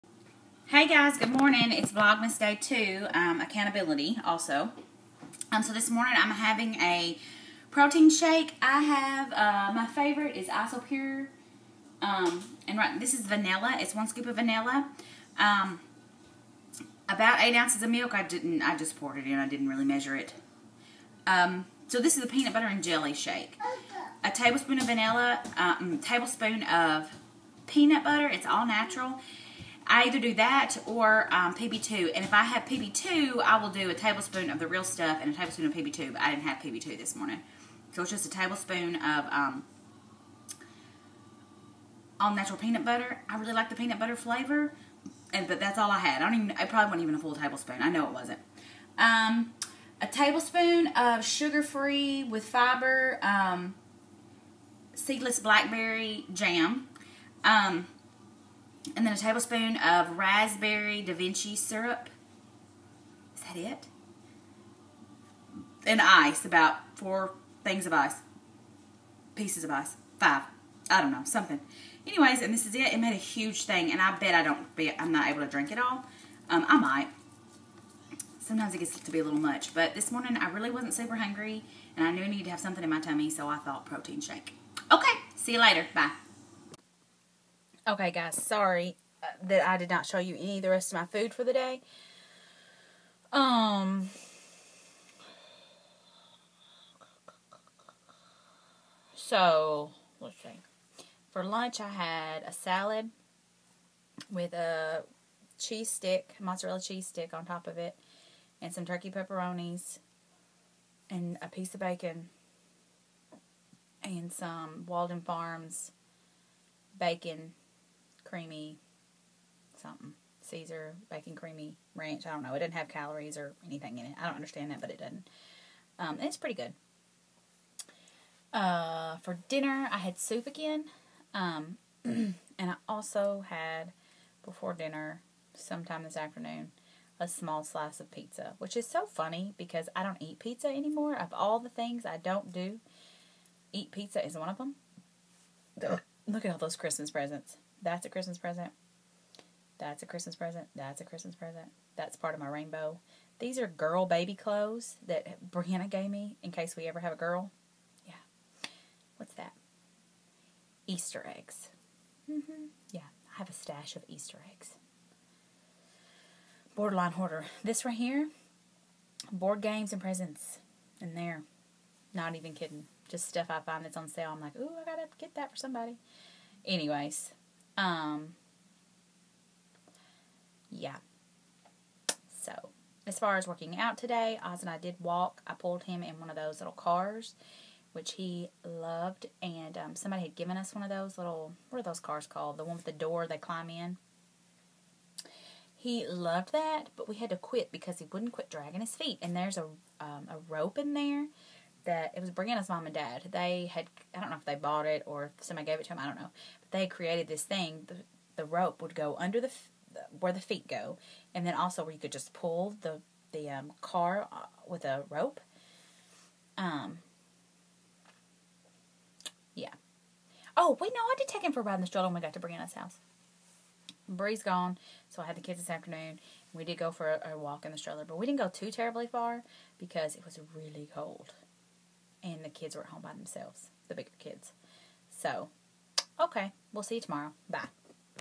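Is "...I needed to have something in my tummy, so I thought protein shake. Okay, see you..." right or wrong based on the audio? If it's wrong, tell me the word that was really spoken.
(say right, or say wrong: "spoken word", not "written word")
right.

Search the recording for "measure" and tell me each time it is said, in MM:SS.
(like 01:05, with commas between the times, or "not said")
00:19.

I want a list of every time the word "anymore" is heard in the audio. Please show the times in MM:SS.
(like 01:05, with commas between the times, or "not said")
02:20.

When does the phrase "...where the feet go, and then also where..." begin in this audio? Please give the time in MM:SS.
03:30.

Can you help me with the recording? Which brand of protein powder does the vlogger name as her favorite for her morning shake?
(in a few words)
Isopure.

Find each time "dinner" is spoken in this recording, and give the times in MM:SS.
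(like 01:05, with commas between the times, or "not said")
02:09, 02:14.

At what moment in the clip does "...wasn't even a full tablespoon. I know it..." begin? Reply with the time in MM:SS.
00:46.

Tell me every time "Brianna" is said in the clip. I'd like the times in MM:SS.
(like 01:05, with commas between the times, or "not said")
02:35, 03:22, 03:42.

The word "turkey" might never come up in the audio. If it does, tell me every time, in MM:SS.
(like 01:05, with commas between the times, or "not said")
01:48.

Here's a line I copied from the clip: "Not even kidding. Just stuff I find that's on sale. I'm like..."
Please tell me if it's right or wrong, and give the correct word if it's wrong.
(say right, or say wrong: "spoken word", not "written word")
right.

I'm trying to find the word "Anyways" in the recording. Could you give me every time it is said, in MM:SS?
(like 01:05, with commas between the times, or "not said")
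01:12, 02:56.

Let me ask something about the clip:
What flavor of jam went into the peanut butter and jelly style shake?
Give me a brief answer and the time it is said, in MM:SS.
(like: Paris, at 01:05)
seedless blackberry, at 00:54.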